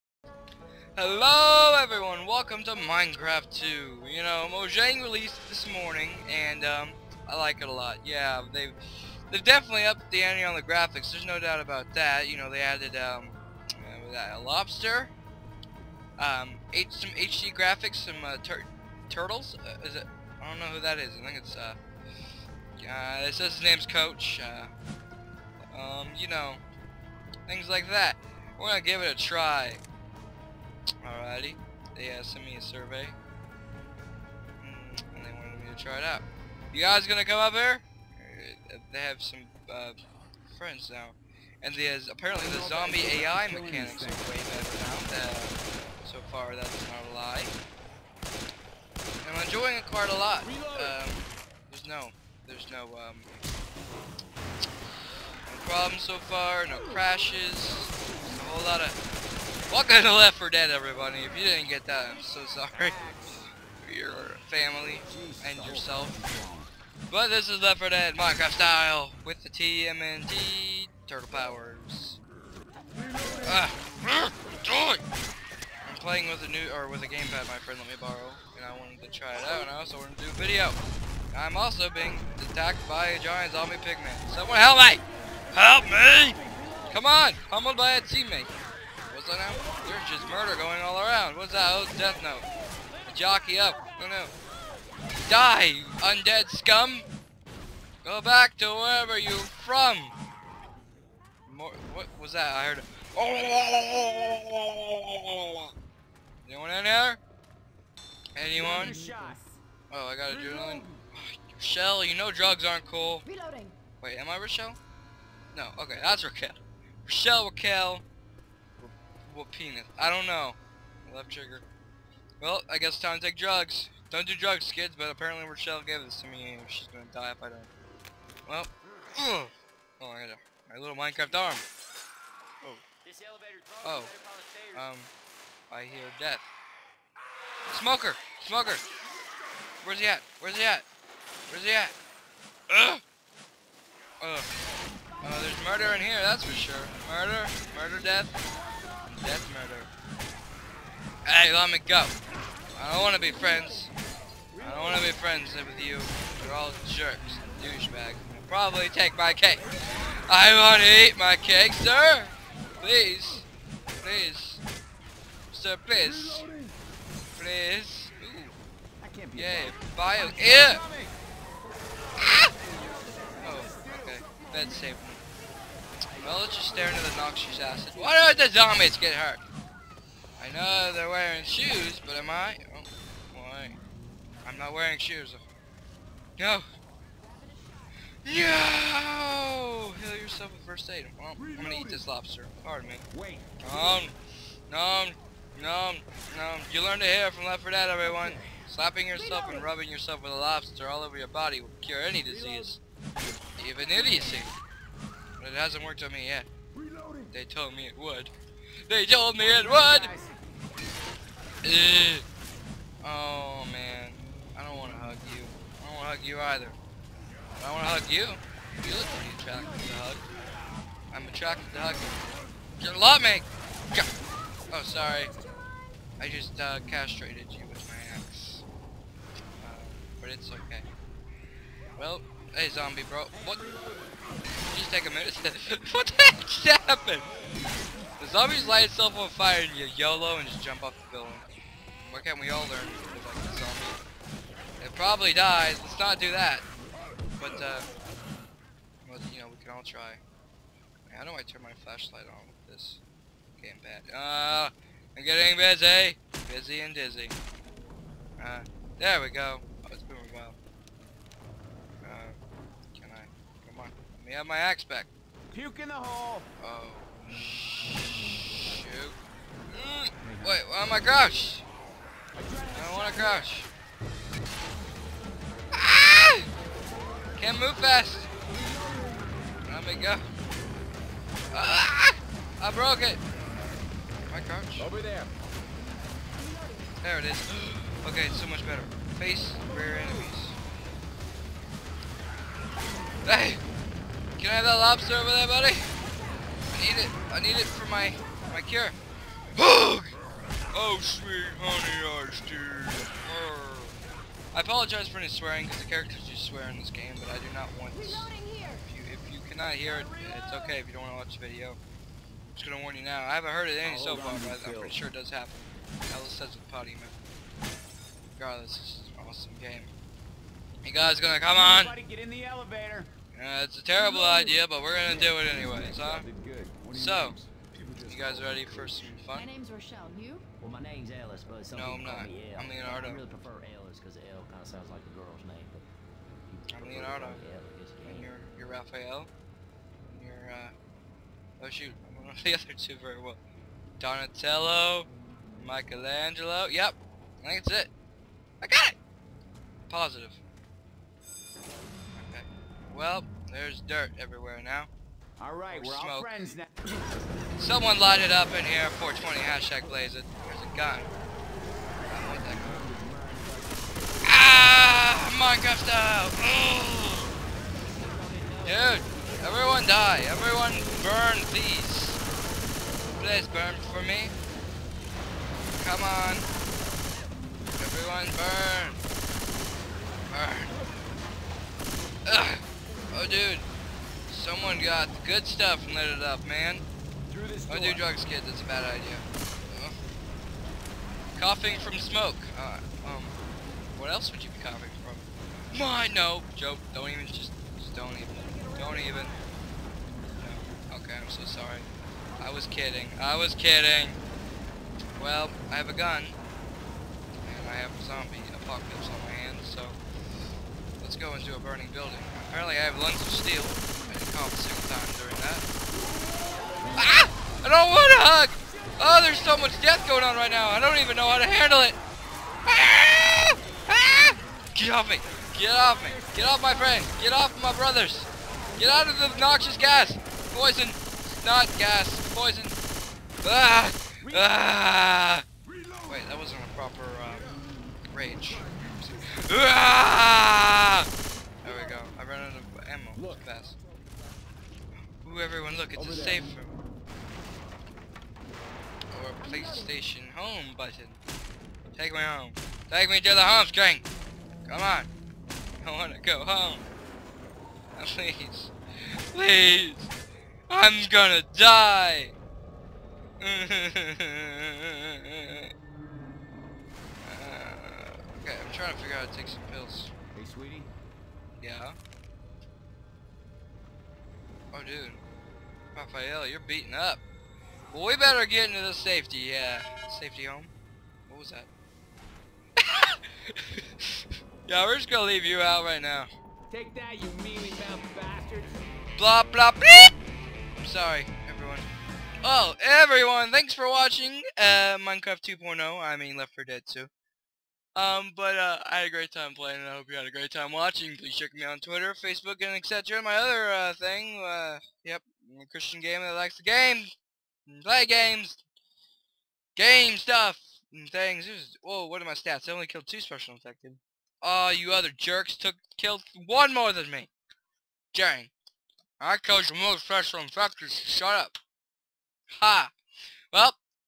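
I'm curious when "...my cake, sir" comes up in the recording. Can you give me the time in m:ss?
2:41.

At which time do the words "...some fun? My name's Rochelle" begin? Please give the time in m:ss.
5:28.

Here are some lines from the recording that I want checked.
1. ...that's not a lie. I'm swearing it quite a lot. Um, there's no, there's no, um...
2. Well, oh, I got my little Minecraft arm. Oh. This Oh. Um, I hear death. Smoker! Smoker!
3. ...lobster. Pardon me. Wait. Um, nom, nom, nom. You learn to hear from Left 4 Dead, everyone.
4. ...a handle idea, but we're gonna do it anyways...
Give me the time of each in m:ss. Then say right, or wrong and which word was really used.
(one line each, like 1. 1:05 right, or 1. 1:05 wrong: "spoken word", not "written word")
1. 0:46 wrong: "enjoying", not "swearing"
2. 2:08 right
3. 3:12 right
4. 5:23 wrong: "terrible", not "handle".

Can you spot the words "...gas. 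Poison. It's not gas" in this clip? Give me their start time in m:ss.
7:09.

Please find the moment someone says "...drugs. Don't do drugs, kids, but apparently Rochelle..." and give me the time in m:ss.
2:03.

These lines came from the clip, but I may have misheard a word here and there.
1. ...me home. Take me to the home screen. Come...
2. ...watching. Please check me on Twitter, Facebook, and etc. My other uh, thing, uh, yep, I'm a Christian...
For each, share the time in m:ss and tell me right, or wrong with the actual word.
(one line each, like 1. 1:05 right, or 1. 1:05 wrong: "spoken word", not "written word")
1. 7:32 right
2. 8:20 right.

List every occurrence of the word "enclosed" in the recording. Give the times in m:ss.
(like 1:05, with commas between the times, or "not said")
not said.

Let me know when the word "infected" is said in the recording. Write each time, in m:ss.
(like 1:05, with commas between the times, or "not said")
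8:33, 8:40.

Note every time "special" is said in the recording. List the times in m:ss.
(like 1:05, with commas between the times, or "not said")
8:33, 8:40.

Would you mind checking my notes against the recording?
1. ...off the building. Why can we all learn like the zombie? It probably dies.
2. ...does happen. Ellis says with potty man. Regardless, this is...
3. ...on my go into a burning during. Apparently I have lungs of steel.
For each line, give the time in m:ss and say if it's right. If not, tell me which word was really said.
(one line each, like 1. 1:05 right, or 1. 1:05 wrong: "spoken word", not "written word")
1. 4:00 right
2. 5:15 right
3. 6:49 wrong: "building", not "during".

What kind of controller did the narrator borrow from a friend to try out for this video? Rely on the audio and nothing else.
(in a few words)
Gamepad.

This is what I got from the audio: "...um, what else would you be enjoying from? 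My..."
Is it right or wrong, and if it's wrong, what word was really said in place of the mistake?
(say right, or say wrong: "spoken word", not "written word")
wrong: "coughing", not "enjoying".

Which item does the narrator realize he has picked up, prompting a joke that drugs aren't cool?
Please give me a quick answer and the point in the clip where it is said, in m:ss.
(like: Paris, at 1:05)
Adrenaline, at 1:50.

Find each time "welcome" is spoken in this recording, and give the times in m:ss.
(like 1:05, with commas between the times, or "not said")
0:02, 0:59.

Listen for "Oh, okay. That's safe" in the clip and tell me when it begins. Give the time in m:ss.
2:53.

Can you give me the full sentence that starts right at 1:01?
If you didn't get that, I'm so sorry.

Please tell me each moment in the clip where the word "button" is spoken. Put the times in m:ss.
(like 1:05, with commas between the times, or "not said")
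7:30.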